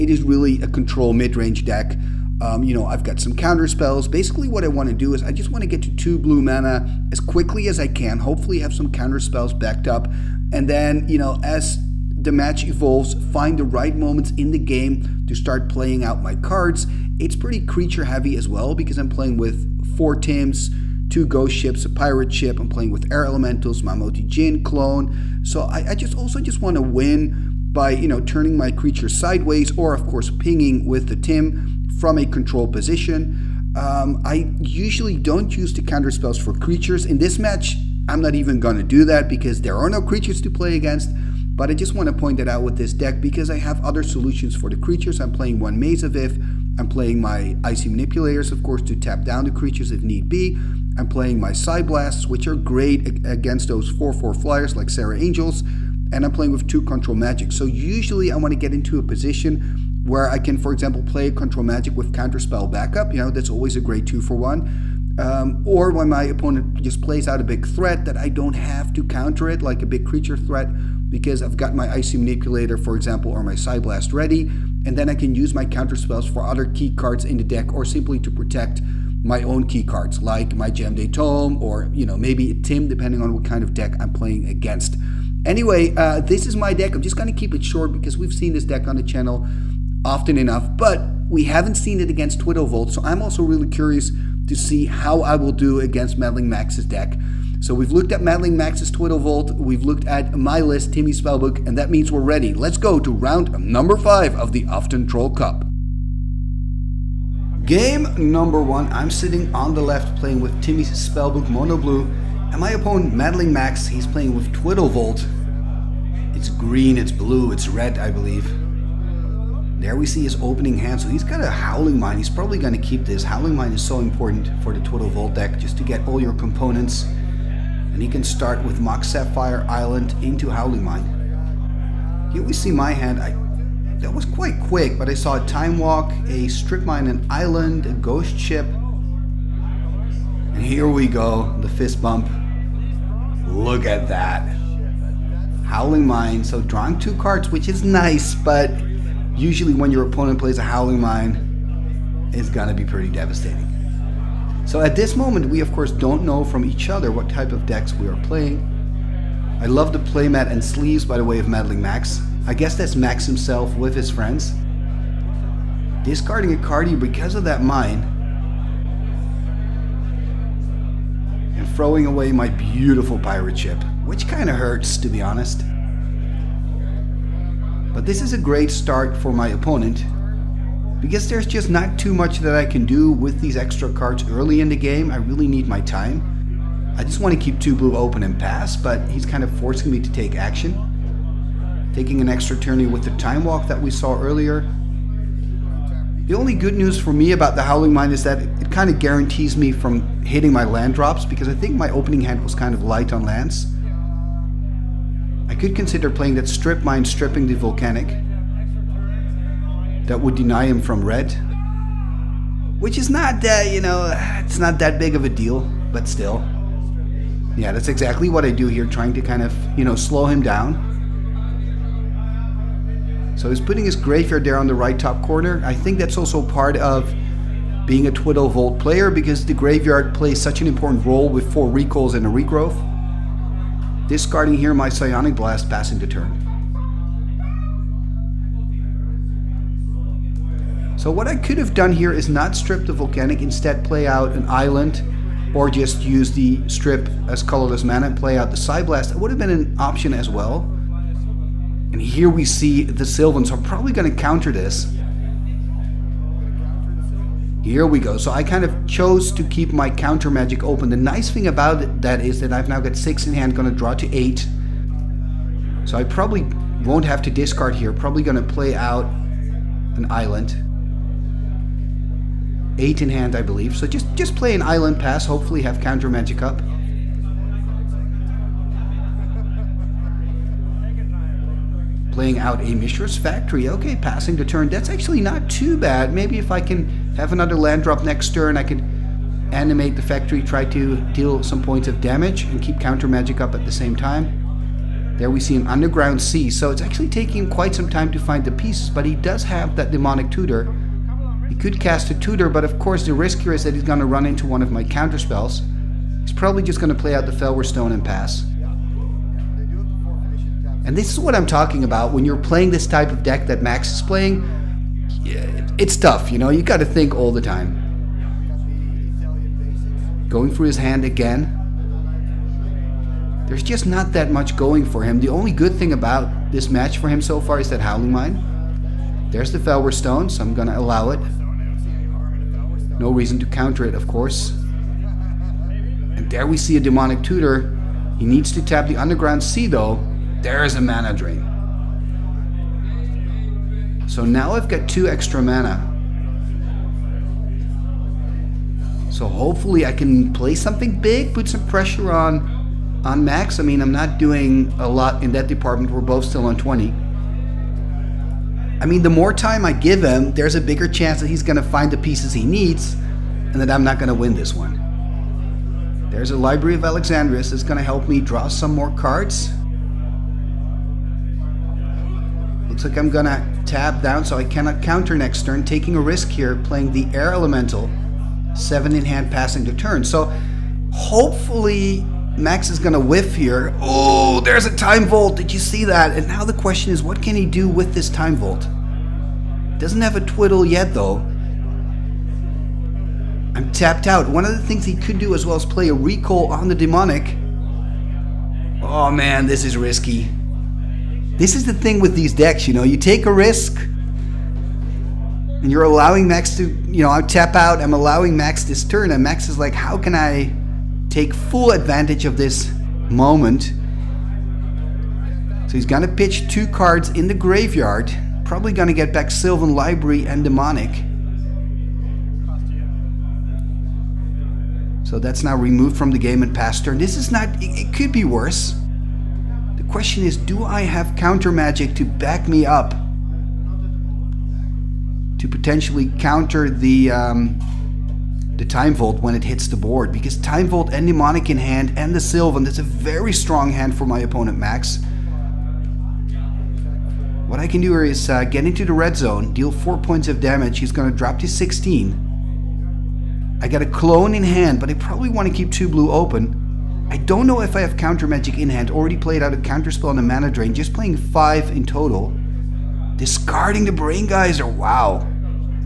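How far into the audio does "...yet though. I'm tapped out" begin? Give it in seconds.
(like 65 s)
390 s.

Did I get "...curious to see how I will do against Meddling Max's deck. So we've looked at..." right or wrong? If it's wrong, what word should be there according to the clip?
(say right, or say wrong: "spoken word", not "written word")
right.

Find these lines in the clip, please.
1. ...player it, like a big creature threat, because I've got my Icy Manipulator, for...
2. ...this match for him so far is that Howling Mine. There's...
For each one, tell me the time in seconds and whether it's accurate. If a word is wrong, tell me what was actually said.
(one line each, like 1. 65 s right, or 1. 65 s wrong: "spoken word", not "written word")
1. 69 s wrong: "counter", not "player"
2. 326 s right.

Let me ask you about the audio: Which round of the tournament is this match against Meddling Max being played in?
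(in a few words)
5.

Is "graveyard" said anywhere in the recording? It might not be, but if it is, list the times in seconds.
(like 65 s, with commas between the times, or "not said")
223 s, 229 s, 417 s.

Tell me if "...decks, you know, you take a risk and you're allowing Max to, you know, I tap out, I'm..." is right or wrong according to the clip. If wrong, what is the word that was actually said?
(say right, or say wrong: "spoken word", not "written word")
right.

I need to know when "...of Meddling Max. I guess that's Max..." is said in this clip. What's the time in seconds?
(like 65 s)
161 s.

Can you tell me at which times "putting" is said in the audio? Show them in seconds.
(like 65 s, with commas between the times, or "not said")
223 s.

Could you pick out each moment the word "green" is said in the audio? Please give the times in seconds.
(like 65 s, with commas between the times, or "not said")
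116 s.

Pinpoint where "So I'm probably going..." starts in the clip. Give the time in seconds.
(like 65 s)
253 s.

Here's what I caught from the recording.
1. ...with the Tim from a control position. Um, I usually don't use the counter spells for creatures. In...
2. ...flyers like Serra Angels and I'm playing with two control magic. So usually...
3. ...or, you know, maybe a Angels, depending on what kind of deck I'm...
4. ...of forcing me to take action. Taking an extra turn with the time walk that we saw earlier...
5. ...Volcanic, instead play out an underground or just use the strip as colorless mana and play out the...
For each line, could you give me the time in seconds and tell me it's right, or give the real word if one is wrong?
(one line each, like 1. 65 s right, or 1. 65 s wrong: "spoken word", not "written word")
1. 30 s right
2. 54 s right
3. 81 s wrong: "Tim", not "Angels"
4. 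189 s right
5. 242 s wrong: "island", not "underground".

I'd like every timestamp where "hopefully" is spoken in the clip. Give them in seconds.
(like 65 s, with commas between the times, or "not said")
8 s, 275 s, 349 s, 380 s.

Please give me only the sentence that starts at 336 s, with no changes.
And there we see a Demonic Tutor.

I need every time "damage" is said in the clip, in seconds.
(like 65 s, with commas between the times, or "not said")
291 s, 450 s.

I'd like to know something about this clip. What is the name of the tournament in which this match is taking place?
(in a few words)
Uthden Troll Cup.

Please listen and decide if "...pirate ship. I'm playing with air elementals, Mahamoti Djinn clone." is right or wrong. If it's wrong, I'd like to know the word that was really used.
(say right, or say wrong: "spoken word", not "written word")
right.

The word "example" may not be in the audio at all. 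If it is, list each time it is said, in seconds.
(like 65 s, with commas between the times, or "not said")
60 s, 72 s.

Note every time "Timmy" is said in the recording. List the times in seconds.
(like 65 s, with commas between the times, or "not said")
100 s, 110 s.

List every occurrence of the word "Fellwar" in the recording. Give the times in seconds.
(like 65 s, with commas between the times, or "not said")
307 s, 329 s.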